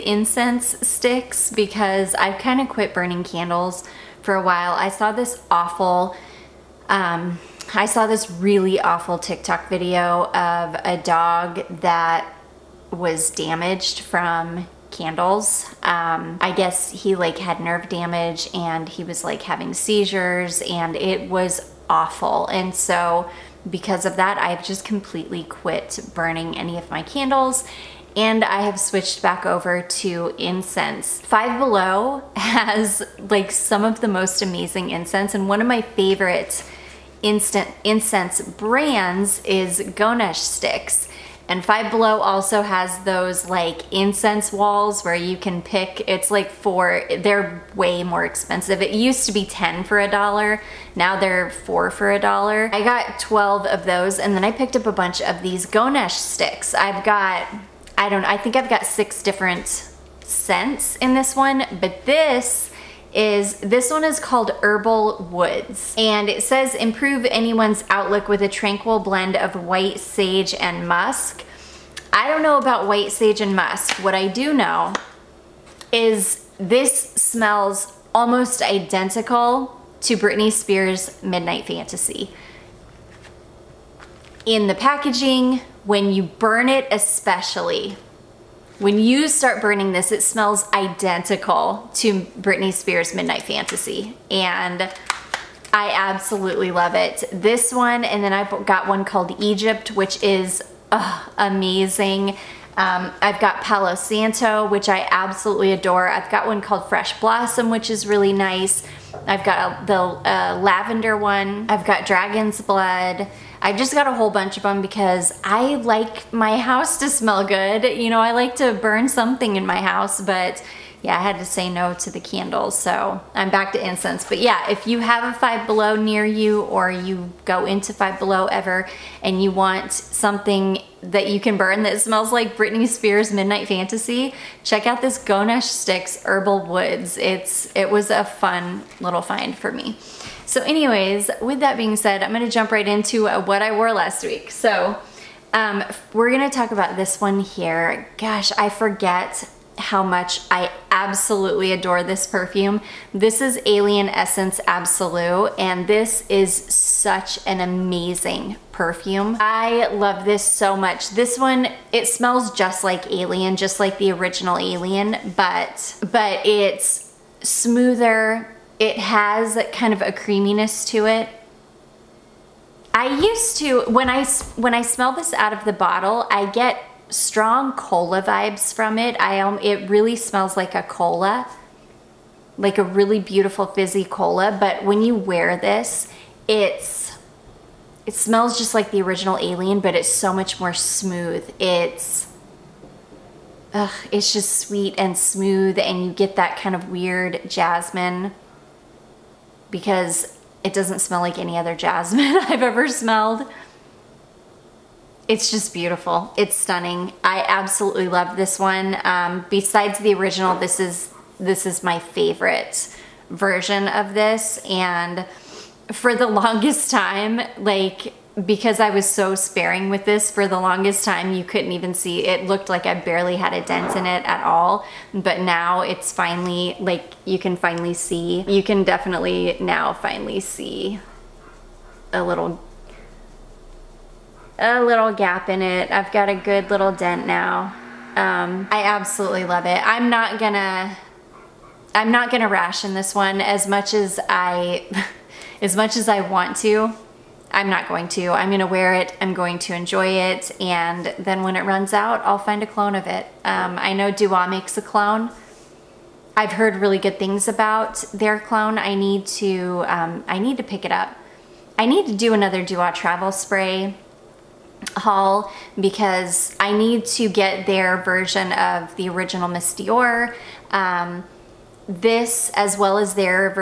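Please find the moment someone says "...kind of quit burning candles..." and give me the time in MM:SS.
00:02.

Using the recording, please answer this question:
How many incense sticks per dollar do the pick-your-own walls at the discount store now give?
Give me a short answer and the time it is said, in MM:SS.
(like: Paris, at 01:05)
4, at 00:50.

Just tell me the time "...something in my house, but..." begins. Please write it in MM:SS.
01:59.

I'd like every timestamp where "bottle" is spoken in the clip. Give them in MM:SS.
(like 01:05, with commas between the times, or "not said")
02:55.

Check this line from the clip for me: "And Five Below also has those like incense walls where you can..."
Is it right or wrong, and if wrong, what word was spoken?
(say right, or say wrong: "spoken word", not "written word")
right.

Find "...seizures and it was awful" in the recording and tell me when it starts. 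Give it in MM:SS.
00:19.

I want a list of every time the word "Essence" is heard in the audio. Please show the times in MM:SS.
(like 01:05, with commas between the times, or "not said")
02:34.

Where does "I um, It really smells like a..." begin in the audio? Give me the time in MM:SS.
02:59.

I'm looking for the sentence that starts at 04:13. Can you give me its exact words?
Um, I know Dua makes a clone.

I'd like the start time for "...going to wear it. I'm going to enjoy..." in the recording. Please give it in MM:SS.
04:08.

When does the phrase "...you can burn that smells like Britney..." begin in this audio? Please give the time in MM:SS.
02:11.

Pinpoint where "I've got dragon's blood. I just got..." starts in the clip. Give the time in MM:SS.
01:51.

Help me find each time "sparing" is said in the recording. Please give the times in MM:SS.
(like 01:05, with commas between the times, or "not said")
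03:39.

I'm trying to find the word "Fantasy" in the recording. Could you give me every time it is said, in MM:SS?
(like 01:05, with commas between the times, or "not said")
01:21, 01:33, 02:13.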